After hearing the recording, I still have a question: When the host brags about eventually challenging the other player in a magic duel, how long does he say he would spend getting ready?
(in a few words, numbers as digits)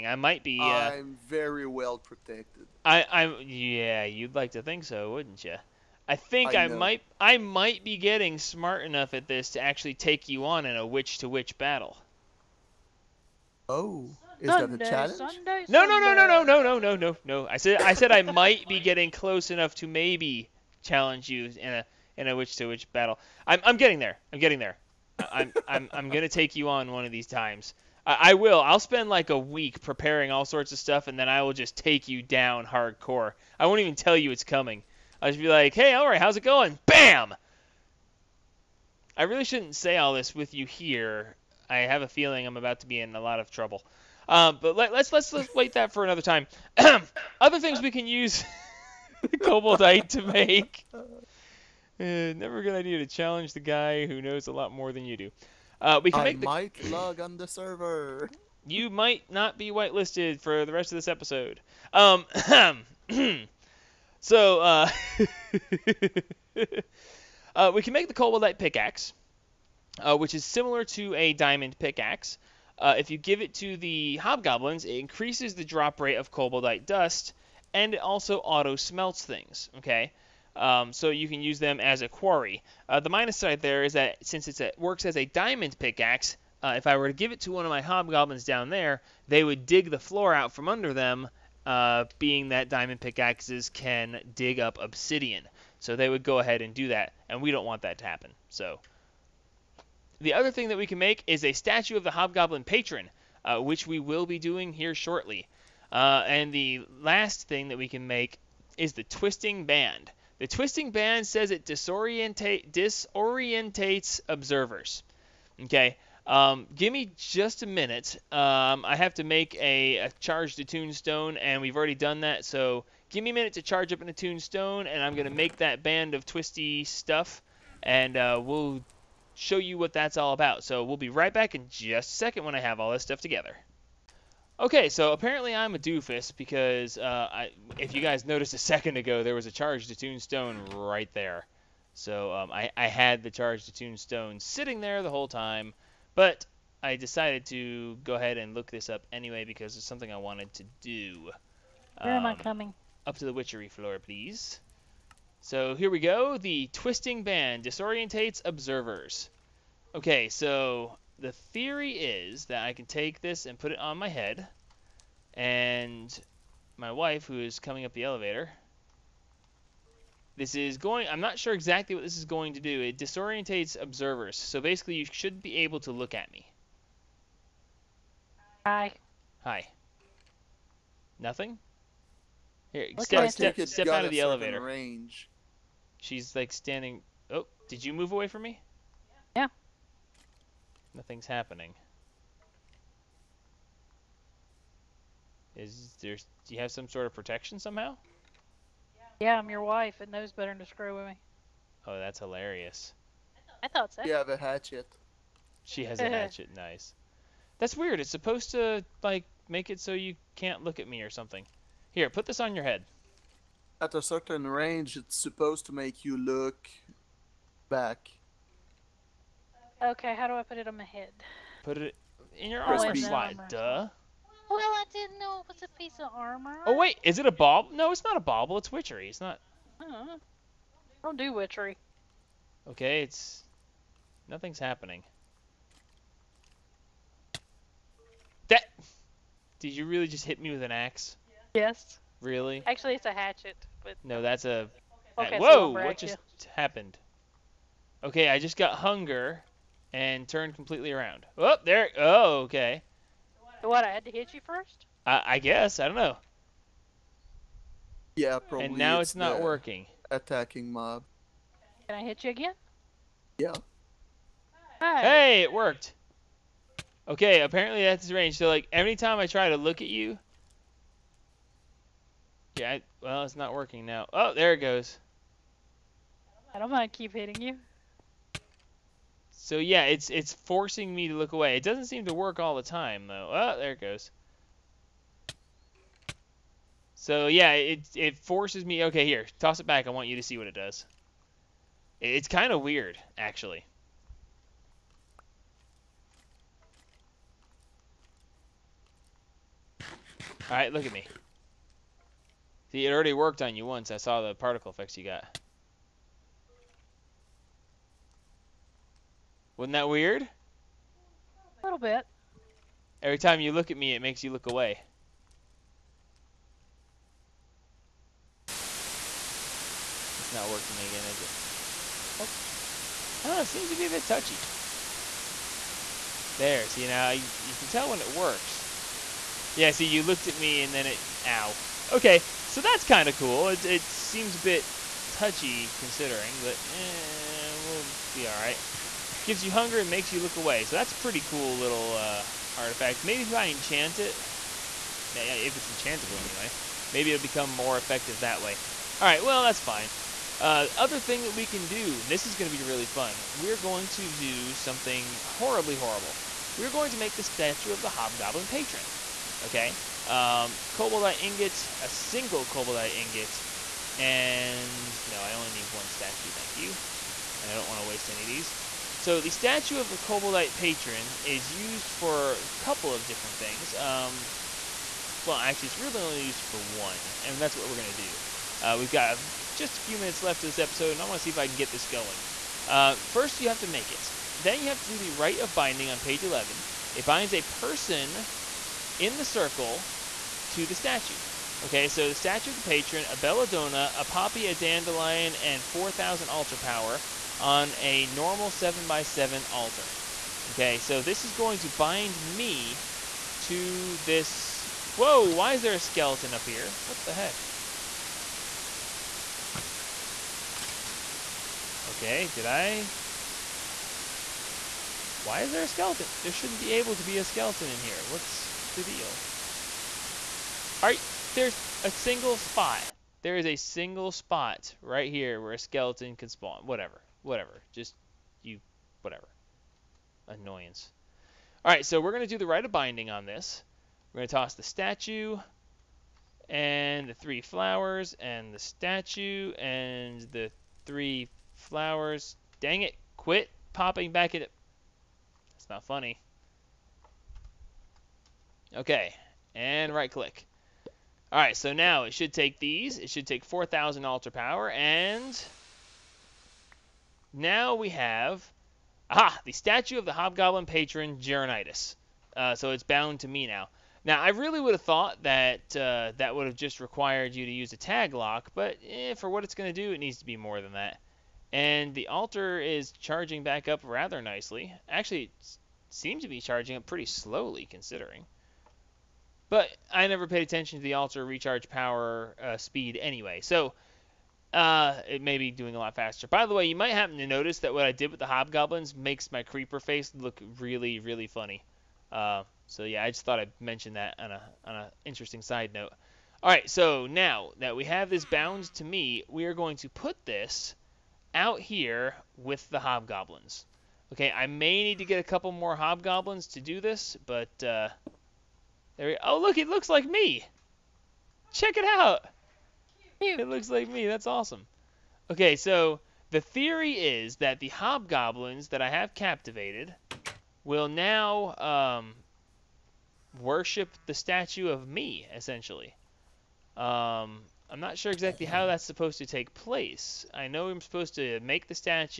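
a week.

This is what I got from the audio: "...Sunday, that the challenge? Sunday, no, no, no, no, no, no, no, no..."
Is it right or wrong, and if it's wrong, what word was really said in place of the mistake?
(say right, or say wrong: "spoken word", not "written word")
right.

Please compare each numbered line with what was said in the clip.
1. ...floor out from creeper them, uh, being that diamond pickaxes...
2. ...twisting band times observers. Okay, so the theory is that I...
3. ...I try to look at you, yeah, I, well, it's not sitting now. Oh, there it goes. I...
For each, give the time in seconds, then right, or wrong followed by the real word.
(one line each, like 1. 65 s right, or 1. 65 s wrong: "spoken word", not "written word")
1. 89 s wrong: "under", not "creeper"
2. 156 s wrong: "disorientates", not "times"
3. 269 s wrong: "working", not "sitting".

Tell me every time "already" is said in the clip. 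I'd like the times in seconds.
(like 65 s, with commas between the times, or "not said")
121 s, 302 s.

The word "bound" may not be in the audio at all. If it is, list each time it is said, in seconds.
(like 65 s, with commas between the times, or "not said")
462 s, 498 s.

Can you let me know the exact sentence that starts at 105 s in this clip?
Uh, and the last thing that we can make is the twisting band.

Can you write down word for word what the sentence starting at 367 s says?
And I don't want to waste any of these.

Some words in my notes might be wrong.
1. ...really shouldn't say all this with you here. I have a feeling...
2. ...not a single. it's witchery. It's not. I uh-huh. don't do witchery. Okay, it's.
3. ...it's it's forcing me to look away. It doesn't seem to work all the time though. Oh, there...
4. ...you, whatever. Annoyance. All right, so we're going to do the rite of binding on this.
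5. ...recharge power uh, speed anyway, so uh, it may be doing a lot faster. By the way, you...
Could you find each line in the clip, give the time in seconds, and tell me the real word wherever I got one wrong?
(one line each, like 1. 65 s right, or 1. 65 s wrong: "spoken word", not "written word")
1. 39 s right
2. 228 s wrong: "bauble", not "single"
3. 279 s right
4. 428 s right
5. 481 s right.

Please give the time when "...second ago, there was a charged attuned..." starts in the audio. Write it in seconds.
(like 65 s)
138 s.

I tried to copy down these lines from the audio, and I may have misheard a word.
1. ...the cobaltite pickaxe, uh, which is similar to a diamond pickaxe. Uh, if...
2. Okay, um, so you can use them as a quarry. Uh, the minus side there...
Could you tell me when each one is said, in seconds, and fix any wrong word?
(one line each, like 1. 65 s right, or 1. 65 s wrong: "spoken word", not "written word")
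1. 68 s right
2. 79 s right.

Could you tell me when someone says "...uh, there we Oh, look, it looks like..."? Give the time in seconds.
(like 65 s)
507 s.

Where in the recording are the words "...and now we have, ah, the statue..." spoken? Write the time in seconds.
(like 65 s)
454 s.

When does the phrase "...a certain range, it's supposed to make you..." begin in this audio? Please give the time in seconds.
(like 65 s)
213 s.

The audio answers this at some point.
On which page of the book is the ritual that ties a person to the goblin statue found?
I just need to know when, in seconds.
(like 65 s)
385 s.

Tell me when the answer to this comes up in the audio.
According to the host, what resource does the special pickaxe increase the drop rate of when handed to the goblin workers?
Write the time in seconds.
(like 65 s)
76 s.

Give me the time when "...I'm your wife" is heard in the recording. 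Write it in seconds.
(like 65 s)
199 s.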